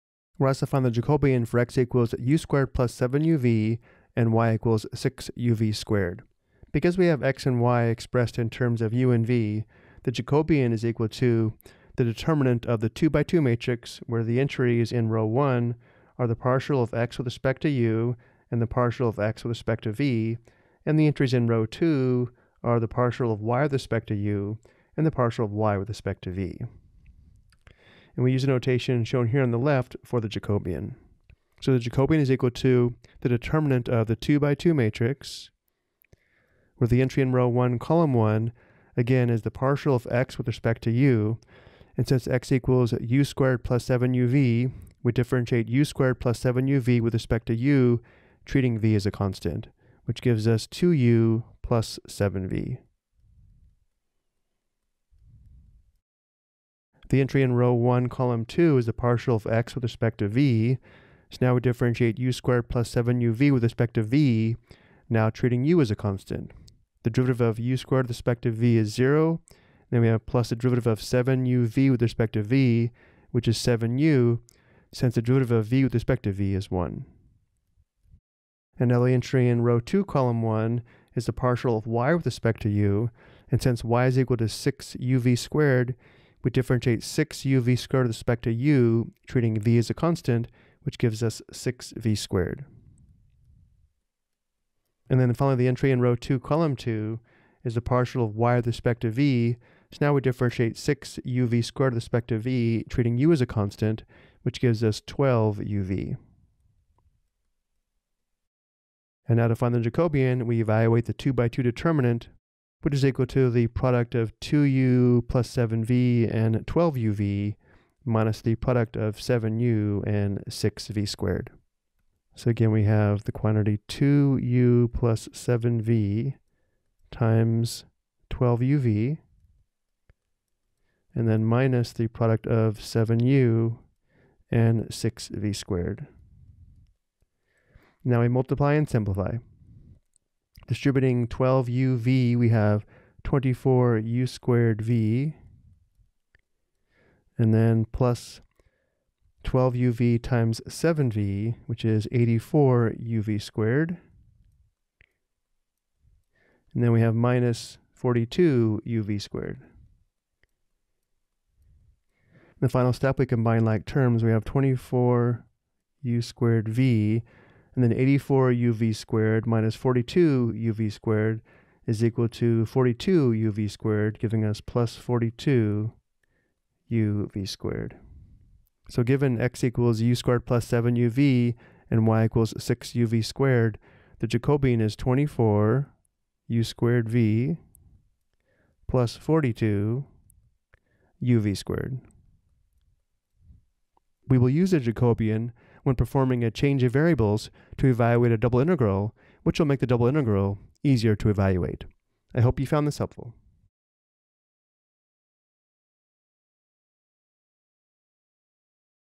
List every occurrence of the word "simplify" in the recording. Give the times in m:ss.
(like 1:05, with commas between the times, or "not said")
2:18.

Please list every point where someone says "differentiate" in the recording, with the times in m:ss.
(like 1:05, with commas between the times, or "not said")
0:45, 1:01, 1:26, 1:40.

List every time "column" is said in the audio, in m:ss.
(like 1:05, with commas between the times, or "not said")
0:37, 0:58, 1:20, 1:36.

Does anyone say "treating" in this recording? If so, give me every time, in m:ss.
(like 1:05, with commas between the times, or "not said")
0:48, 1:05, 1:29, 1:42.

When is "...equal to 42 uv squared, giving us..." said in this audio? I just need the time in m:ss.
2:52.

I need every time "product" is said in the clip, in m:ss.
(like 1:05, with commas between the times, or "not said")
1:53, 1:58, 2:12.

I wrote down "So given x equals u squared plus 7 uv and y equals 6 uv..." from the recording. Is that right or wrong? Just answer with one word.
right.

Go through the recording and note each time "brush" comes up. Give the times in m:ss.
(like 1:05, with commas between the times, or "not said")
not said.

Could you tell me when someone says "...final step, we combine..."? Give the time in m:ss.
2:42.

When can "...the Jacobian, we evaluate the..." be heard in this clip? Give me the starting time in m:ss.
1:49.